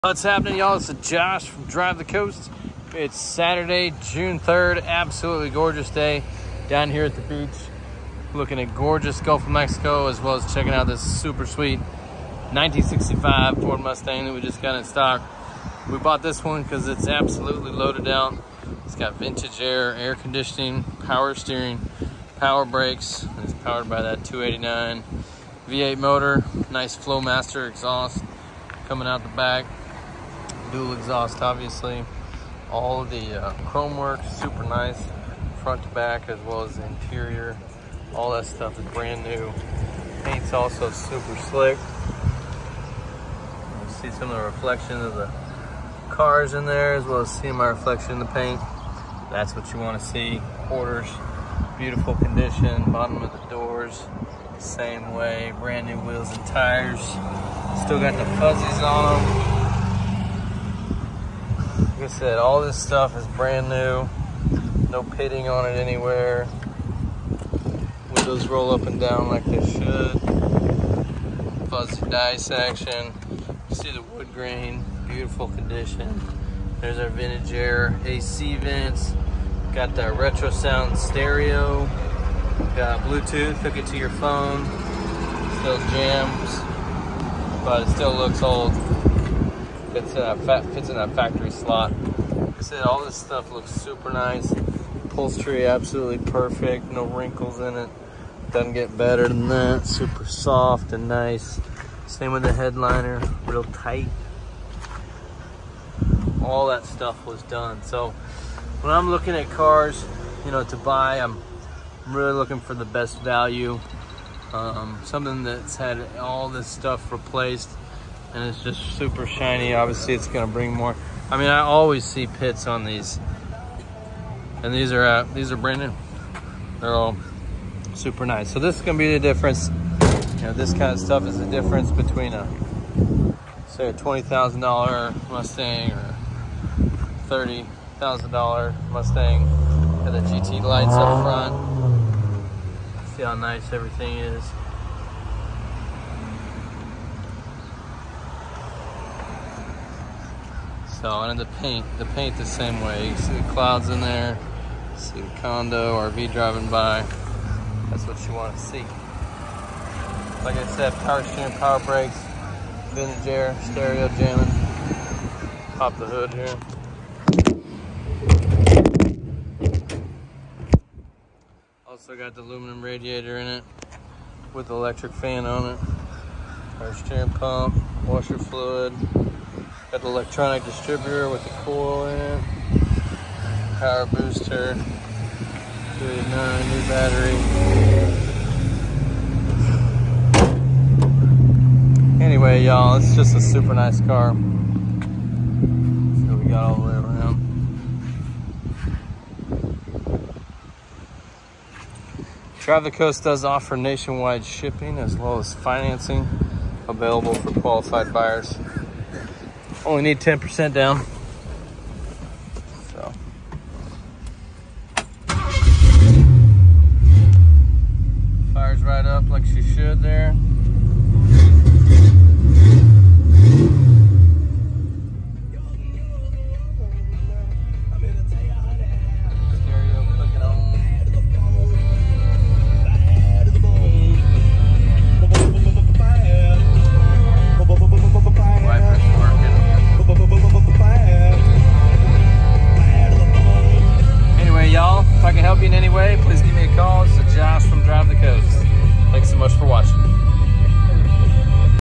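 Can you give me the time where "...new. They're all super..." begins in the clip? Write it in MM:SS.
02:05.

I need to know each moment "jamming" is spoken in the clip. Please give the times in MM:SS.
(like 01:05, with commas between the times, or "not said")
02:44.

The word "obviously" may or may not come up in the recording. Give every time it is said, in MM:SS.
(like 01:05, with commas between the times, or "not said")
00:31, 01:59.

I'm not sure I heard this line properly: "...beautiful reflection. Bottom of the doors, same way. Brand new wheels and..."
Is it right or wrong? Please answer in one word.
wrong.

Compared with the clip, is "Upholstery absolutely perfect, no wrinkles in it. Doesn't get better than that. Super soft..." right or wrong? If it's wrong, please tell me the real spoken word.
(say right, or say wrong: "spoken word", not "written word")
right.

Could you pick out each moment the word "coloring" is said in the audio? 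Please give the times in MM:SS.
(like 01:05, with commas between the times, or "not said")
not said.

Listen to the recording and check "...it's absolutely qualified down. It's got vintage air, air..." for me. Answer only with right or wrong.
wrong.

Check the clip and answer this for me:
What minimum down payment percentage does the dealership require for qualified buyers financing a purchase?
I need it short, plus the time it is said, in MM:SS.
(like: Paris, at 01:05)
10%, at 03:30.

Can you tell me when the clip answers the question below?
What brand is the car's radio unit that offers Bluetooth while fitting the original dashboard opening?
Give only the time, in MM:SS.
01:20.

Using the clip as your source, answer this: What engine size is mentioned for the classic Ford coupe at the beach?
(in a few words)
289 V8.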